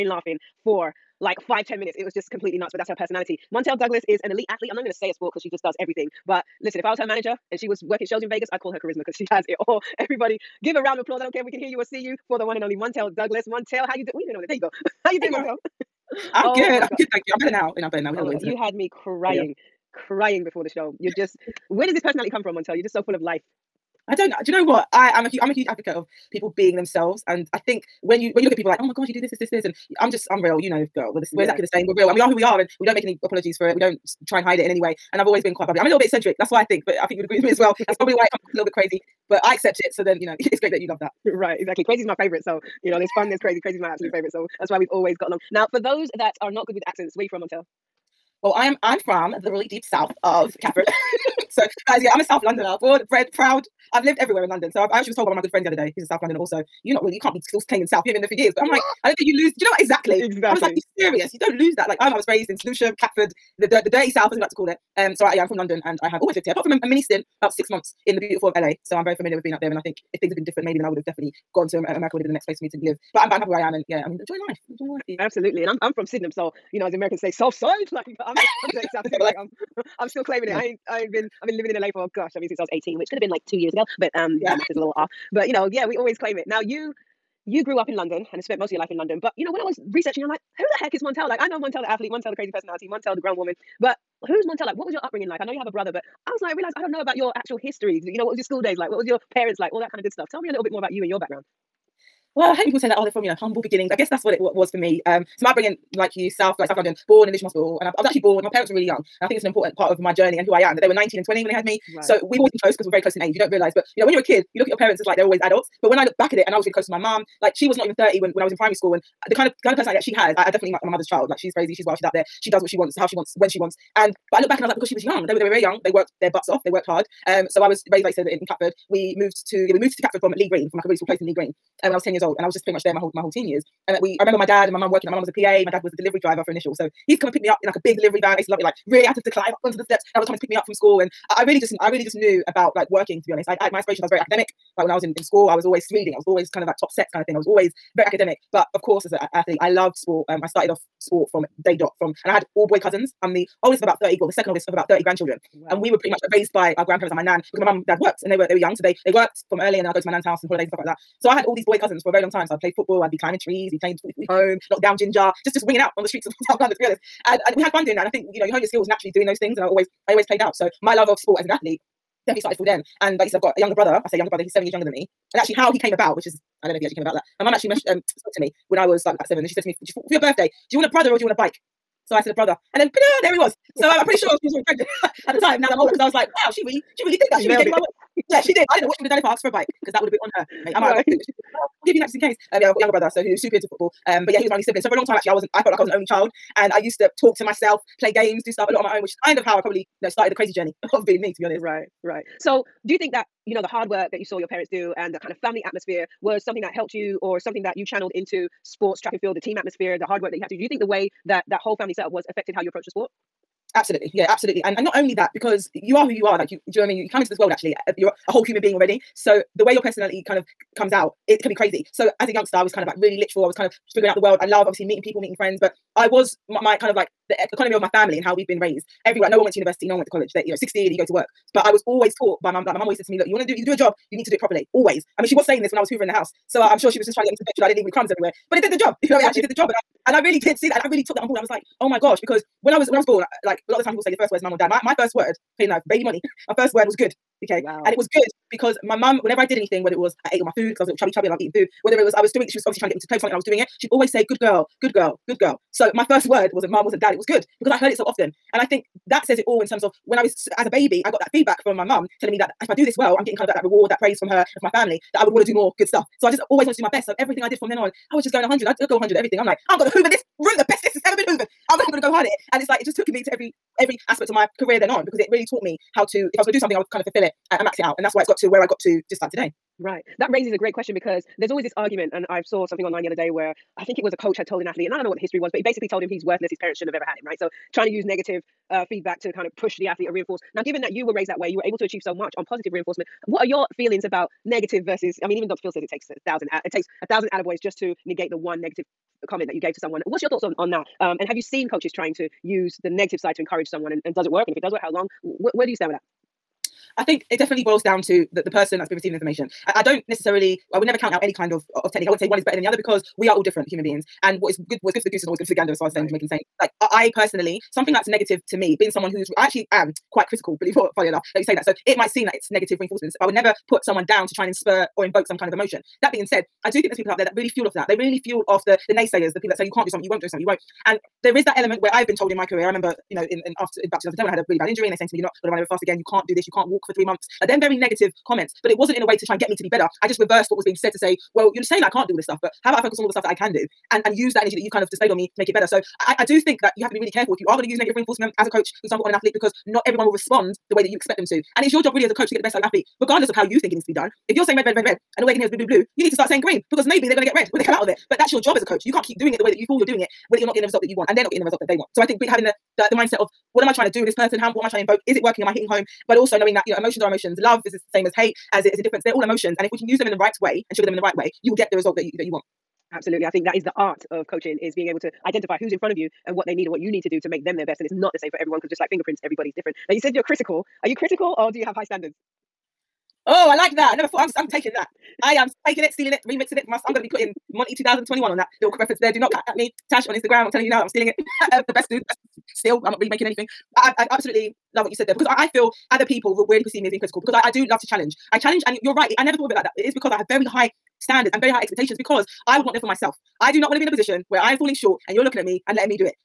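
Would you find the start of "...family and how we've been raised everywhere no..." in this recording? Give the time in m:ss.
3:47.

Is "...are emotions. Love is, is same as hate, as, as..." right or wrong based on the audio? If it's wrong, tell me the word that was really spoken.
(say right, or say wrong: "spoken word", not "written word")
right.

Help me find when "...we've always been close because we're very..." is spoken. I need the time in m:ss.
1:52.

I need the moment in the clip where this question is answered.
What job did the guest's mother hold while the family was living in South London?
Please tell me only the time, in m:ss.
2:15.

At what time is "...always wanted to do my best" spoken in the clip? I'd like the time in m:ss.
4:26.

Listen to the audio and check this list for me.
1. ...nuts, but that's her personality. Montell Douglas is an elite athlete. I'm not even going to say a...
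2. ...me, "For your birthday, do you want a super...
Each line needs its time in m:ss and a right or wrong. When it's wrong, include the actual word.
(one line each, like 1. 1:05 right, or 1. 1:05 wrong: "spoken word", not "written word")
1. 0:02 right
2. 2:59 wrong: "brother", not "super".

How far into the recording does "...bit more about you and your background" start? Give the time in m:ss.
1:40.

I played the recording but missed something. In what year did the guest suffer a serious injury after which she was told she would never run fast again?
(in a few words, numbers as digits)
2010.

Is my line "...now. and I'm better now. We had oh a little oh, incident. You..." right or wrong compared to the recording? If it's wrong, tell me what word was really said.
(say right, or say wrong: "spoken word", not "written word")
right.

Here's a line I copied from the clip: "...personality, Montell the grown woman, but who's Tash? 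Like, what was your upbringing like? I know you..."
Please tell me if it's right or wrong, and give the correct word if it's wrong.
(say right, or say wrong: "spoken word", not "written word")
wrong: "Montell", not "Tash".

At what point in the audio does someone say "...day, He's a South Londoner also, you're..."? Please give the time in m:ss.
0:55.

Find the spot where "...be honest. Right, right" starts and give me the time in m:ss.
3:21.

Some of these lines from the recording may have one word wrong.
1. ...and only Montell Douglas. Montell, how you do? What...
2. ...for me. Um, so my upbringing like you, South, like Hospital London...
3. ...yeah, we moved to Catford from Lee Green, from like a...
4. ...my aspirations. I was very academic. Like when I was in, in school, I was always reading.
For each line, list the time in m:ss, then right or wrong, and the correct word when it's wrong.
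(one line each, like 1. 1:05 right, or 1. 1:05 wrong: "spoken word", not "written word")
1. 0:12 right
2. 1:44 wrong: "South", not "Hospital"
3. 2:09 right
4. 2:23 right.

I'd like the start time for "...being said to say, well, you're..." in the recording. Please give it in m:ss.
5:40.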